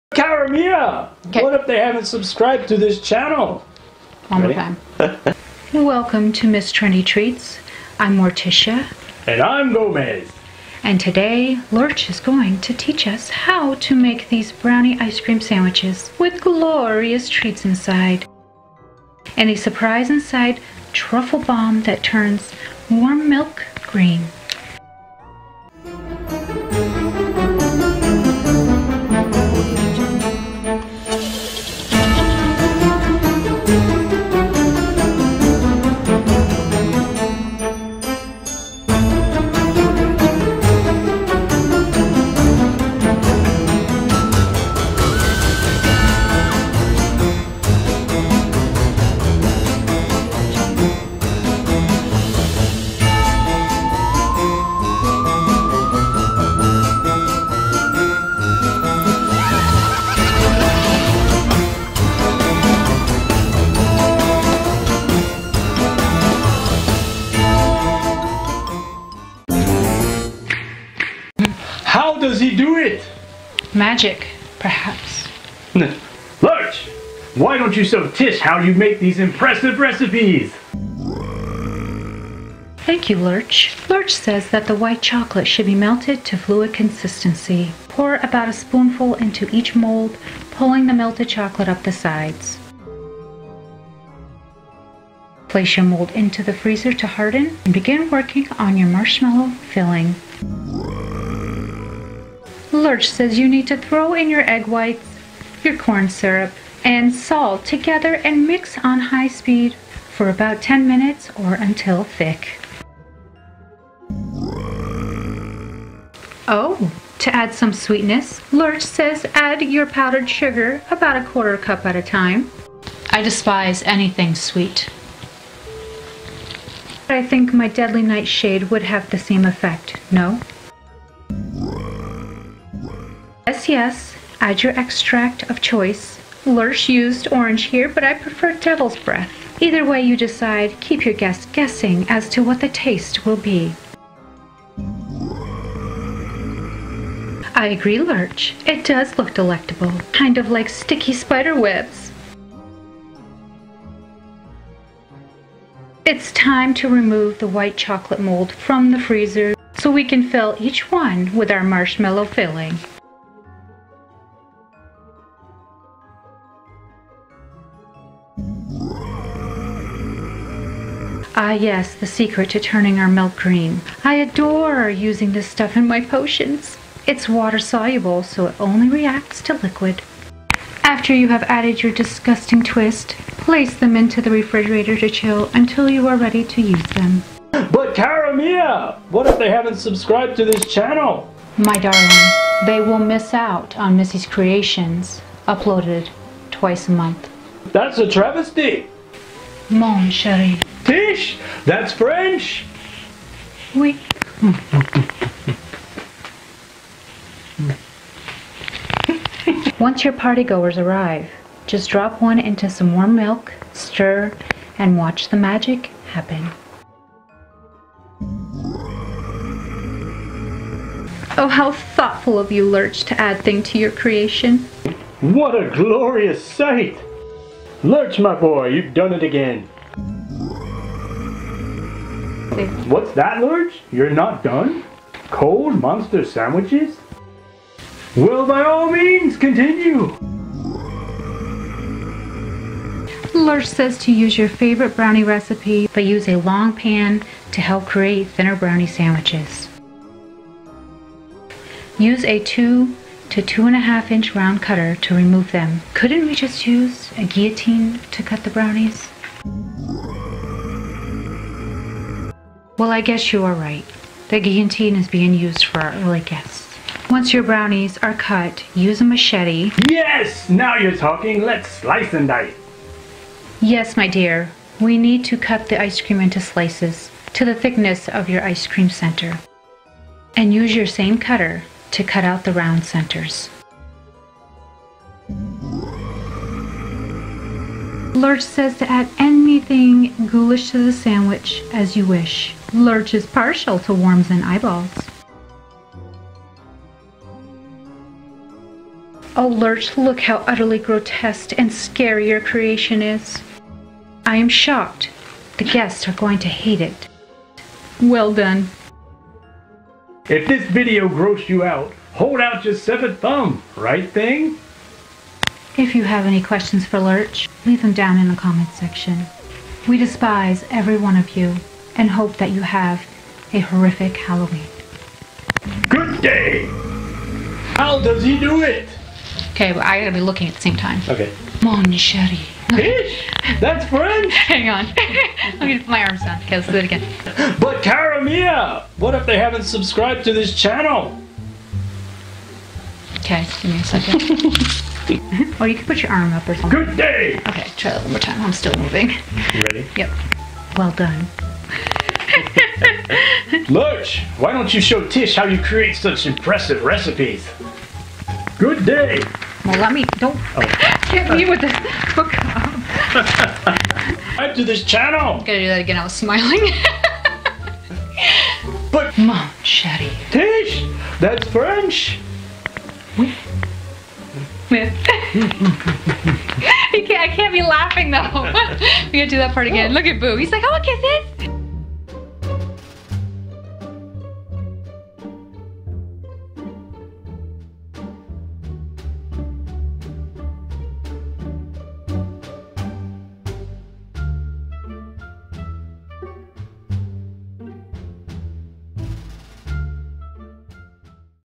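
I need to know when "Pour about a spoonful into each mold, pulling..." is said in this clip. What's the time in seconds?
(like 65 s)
87 s.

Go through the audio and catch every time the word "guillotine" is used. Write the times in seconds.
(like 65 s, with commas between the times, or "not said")
257 s, 264 s.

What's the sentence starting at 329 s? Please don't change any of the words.
Okay, I gotta be looking at the same time.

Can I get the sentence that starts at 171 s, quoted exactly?
Ah, yes, the secret to turning our milk green.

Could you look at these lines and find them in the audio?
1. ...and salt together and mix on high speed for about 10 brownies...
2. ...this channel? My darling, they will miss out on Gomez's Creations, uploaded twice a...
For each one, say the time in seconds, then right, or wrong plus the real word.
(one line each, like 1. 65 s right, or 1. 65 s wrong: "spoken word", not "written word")
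1. 106 s wrong: "minutes", not "brownies"
2. 190 s wrong: "Missy", not "Gomez".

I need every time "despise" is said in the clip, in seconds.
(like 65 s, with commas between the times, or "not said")
123 s, 319 s.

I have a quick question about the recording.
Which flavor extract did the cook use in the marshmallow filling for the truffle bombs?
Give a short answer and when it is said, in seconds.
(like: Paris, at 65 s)
orange, at 137 s.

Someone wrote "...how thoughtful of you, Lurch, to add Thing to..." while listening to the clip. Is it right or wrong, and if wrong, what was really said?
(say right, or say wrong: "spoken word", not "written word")
right.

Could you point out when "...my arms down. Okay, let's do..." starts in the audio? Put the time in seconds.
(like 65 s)
335 s.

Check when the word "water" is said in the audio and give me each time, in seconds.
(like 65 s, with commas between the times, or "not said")
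177 s.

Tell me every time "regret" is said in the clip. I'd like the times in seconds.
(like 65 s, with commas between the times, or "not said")
not said.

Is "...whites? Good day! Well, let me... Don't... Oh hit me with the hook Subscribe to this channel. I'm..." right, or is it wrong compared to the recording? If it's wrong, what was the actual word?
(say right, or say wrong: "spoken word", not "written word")
wrong: "recipes", not "whites".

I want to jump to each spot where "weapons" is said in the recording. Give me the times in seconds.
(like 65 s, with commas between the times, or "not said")
not said.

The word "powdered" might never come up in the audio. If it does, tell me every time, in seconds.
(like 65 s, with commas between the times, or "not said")
119 s.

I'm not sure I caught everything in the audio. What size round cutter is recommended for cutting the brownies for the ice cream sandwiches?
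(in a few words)
2 to 2.5 inch.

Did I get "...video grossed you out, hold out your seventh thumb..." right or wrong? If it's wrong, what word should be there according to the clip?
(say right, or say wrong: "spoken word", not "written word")
right.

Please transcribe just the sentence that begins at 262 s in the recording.
Well, I guess you are right.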